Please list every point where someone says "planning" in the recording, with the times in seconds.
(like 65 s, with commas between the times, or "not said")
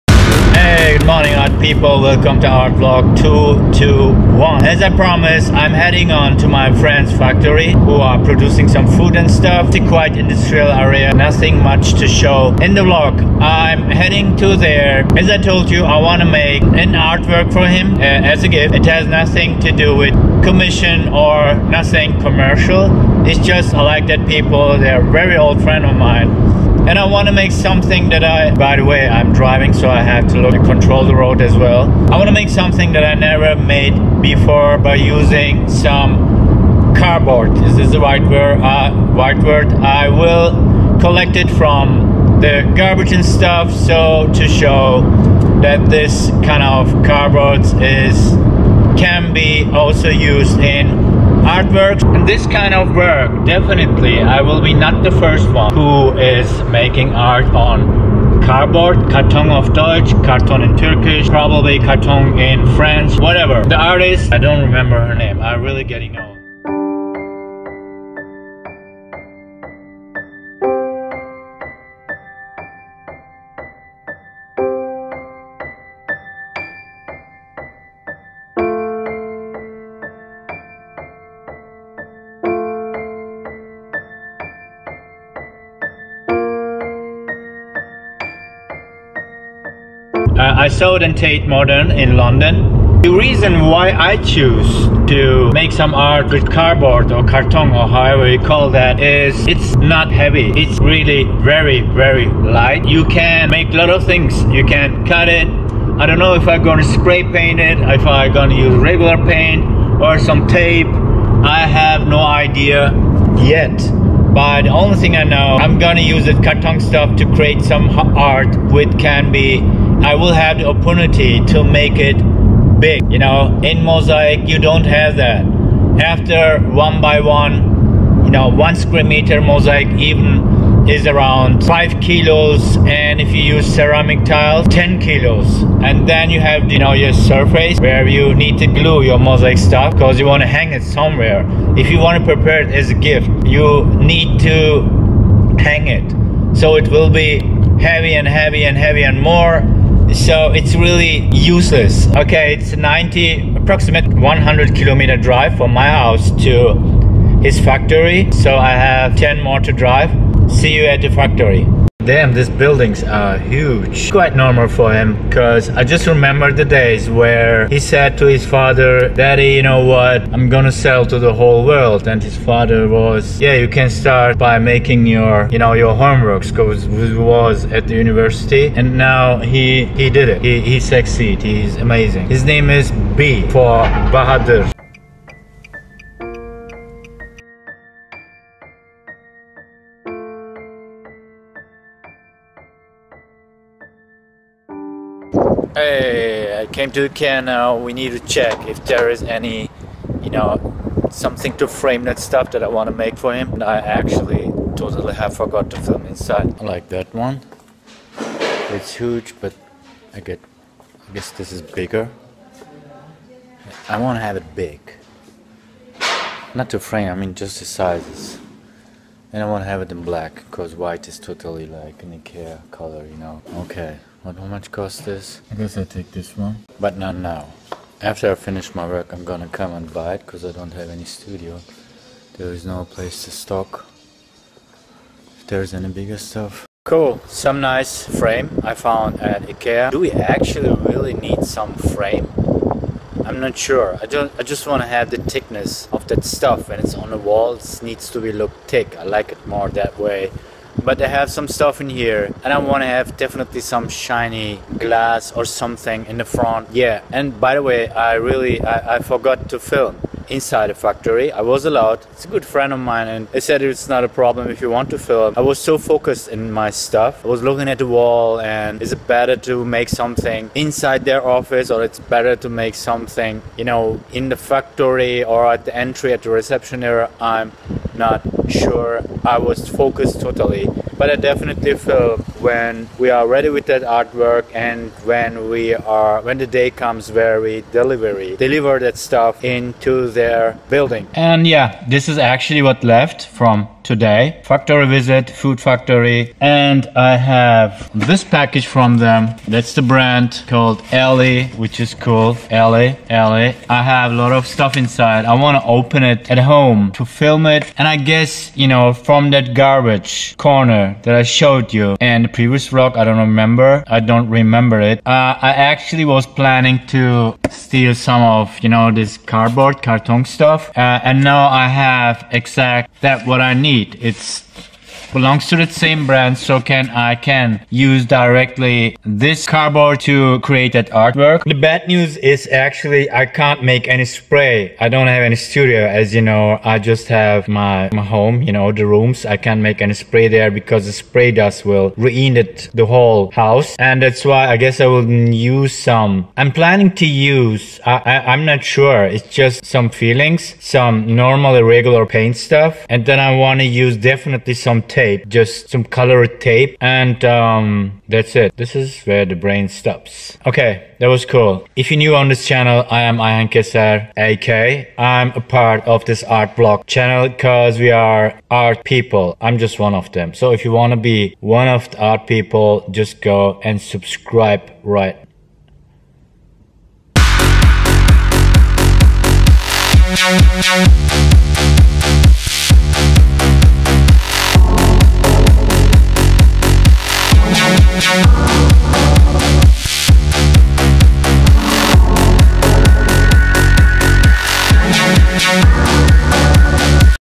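316 s, 346 s.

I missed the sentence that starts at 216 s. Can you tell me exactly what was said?
Not to frame, I mean just the sizes.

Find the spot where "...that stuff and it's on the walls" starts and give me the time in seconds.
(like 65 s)
246 s.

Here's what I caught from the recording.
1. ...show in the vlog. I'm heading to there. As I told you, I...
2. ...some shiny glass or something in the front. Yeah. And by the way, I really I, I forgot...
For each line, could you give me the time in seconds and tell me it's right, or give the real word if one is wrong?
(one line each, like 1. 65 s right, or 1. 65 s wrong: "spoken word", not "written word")
1. 12 s right
2. 253 s right.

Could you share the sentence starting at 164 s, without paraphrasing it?
Quite normal for him, because I just remember the days where he said to his father, Daddy, you know what?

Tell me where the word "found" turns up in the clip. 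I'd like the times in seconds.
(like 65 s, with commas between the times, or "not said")
238 s.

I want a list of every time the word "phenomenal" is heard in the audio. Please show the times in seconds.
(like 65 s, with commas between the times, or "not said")
not said.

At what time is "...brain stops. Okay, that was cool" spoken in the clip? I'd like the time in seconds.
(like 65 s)
359 s.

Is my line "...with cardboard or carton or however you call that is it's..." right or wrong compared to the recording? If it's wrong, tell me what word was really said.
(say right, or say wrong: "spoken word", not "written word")
right.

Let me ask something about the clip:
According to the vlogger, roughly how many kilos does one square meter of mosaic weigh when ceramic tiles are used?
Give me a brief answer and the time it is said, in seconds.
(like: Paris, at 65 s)
10 kilos, at 134 s.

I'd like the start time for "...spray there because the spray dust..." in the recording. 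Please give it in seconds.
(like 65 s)
339 s.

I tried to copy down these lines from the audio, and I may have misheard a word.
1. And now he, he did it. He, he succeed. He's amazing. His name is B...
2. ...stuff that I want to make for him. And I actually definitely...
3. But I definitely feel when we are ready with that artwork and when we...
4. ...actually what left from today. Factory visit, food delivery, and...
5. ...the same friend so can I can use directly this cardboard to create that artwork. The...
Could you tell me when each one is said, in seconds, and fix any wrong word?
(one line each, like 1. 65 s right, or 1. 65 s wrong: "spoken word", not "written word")
1. 178 s right
2. 202 s wrong: "totally", not "definitely"
3. 281 s right
4. 292 s wrong: "factory", not "delivery"
5. 325 s wrong: "brand", not "friend".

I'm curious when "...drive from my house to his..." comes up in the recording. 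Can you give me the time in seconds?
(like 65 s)
155 s.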